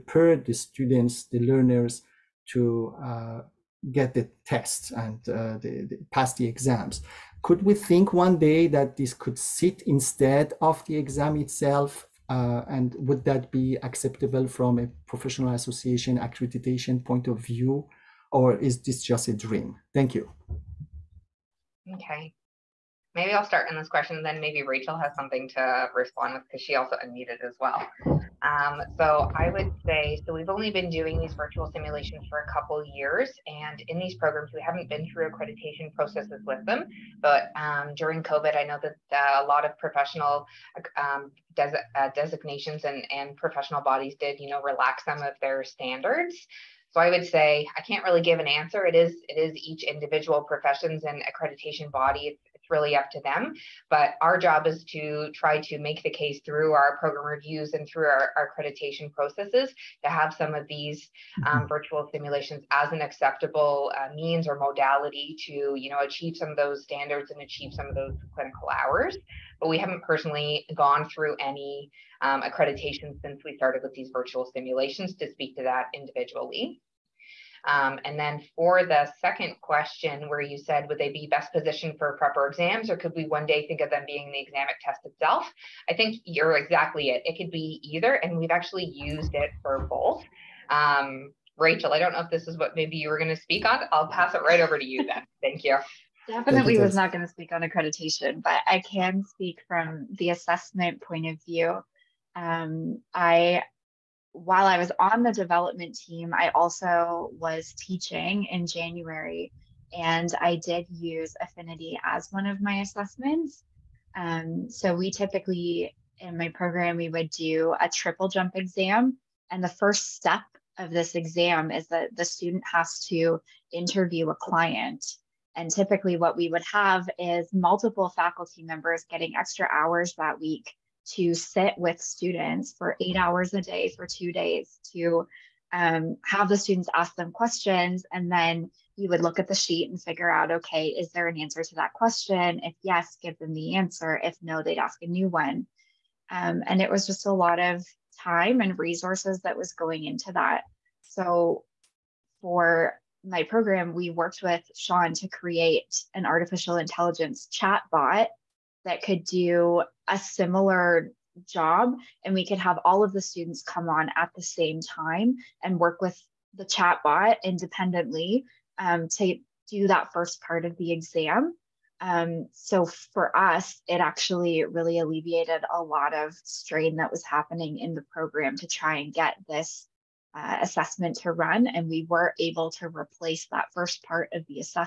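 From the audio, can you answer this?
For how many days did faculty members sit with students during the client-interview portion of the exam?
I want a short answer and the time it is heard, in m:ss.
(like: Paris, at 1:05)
2, at 2:14.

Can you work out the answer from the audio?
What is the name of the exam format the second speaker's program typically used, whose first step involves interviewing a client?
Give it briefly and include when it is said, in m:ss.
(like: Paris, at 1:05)
triple jump exam, at 1:57.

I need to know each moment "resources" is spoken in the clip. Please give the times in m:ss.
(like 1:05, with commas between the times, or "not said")
2:28.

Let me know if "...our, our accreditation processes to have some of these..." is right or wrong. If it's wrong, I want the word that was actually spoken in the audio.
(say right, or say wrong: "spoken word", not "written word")
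right.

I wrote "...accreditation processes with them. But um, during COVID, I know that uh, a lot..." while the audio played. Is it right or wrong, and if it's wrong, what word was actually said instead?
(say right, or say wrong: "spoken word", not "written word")
right.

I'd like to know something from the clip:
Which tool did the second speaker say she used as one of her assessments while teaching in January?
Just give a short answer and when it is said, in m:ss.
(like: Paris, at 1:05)
Affinity, at 1:51.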